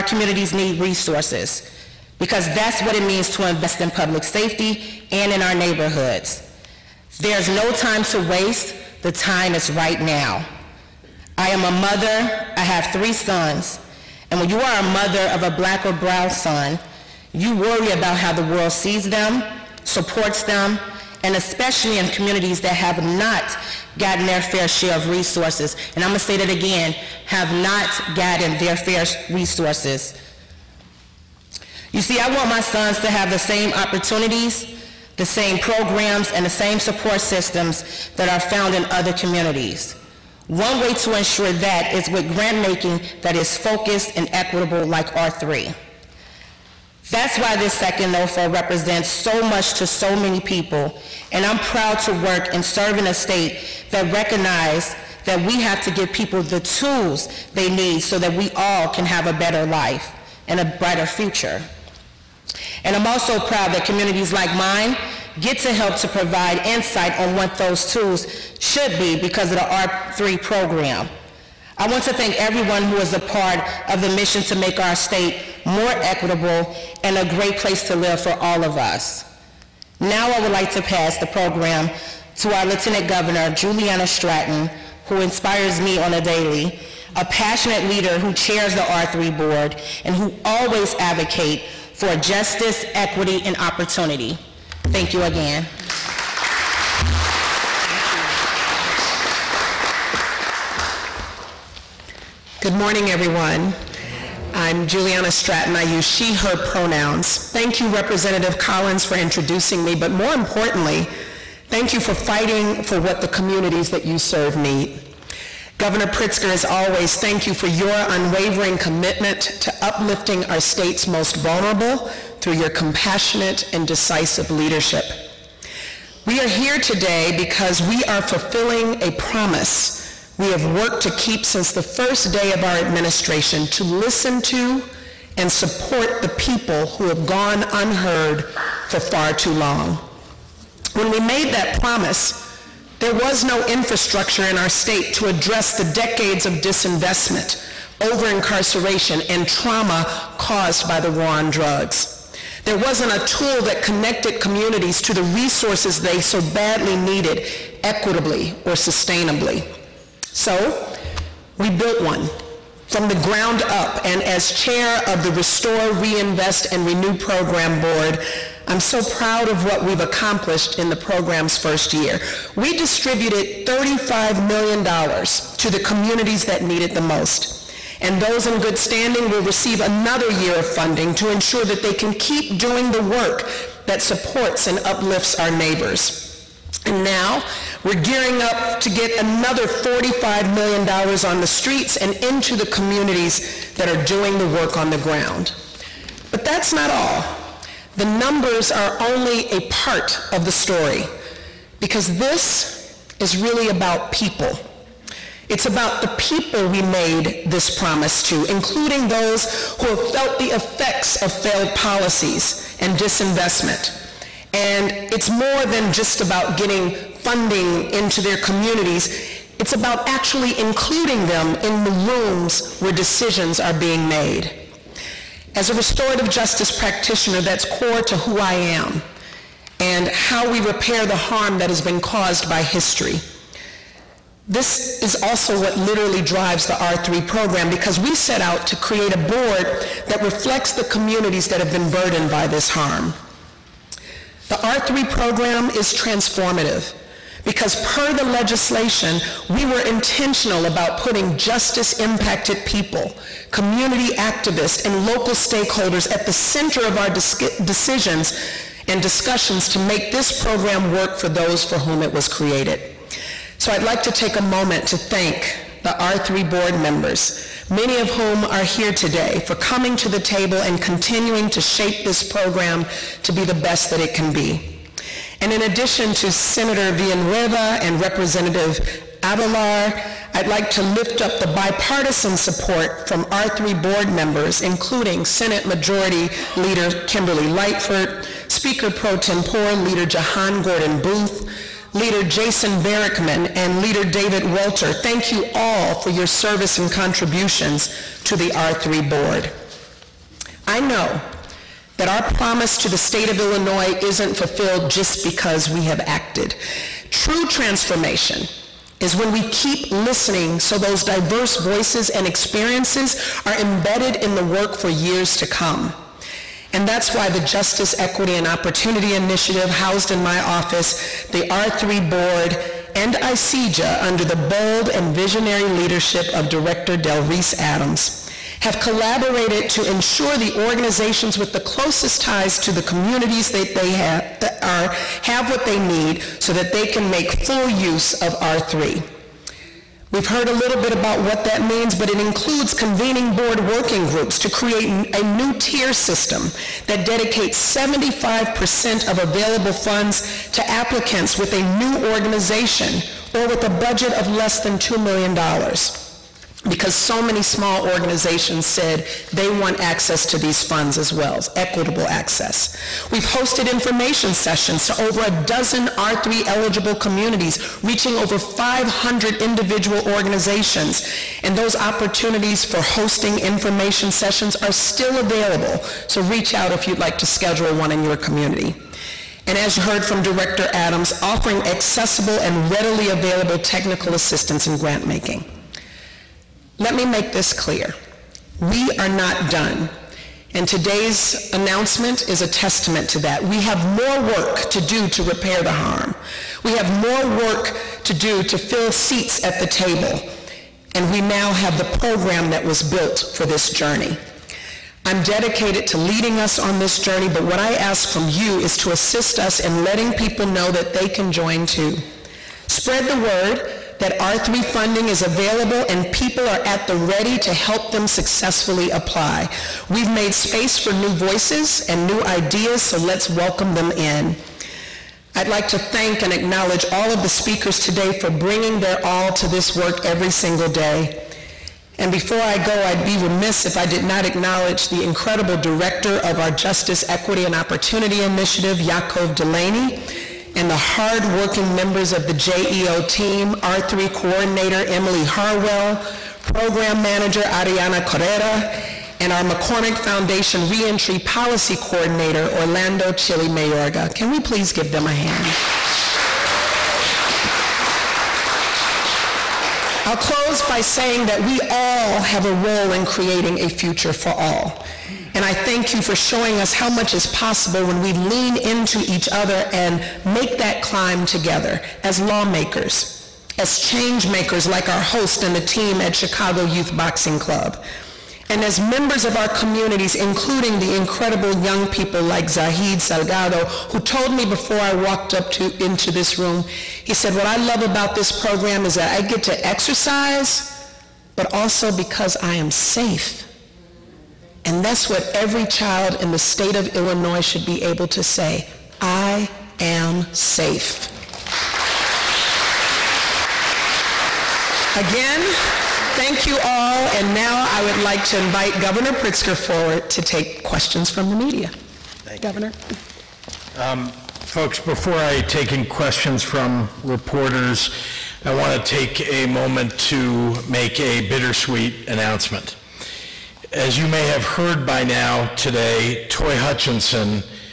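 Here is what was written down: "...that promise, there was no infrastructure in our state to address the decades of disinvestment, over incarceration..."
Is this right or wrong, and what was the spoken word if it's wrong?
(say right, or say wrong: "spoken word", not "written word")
right.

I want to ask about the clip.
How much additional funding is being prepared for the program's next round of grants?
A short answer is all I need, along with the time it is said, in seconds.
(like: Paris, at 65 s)
$45 million, at 189 s.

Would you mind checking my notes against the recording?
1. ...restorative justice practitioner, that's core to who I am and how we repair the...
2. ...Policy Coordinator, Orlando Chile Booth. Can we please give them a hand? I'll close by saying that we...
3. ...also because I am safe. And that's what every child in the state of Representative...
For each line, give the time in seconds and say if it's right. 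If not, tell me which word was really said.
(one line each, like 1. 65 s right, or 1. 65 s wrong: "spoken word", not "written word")
1. 225 s right
2. 451 s wrong: "Mayorga", not "Booth"
3. 491 s wrong: "Illinois", not "Representative".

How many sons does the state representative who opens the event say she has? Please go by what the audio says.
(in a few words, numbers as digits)
3.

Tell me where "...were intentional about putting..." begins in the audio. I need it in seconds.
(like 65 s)
249 s.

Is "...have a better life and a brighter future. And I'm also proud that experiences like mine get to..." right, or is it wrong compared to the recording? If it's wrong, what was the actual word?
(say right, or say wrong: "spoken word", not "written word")
wrong: "communities", not "experiences".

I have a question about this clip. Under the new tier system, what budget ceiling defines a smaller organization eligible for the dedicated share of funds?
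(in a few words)
$2 million.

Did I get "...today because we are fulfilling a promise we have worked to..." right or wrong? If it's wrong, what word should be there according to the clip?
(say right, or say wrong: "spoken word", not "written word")
right.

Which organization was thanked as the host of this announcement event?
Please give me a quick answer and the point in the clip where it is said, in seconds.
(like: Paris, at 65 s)
Chicago Youth Boxing Club, at 476 s.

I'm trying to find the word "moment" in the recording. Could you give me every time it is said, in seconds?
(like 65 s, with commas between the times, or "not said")
264 s, 519 s.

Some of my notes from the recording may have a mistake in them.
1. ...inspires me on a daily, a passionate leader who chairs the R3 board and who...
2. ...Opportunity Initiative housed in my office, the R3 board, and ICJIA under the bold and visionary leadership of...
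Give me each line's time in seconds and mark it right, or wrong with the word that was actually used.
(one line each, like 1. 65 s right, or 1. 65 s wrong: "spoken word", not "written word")
1. 85 s right
2. 318 s right.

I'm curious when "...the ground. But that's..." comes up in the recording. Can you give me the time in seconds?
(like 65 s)
194 s.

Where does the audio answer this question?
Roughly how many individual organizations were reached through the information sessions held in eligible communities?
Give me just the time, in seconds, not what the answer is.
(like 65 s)
368 s.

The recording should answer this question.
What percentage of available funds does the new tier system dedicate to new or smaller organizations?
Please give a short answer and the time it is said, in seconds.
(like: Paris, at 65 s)
75%, at 347 s.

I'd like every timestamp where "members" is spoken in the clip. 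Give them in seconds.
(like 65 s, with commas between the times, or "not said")
266 s, 284 s, 441 s, 478 s.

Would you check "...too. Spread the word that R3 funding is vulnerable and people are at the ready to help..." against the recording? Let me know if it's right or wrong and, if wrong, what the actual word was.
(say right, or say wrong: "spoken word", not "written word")
wrong: "available", not "vulnerable".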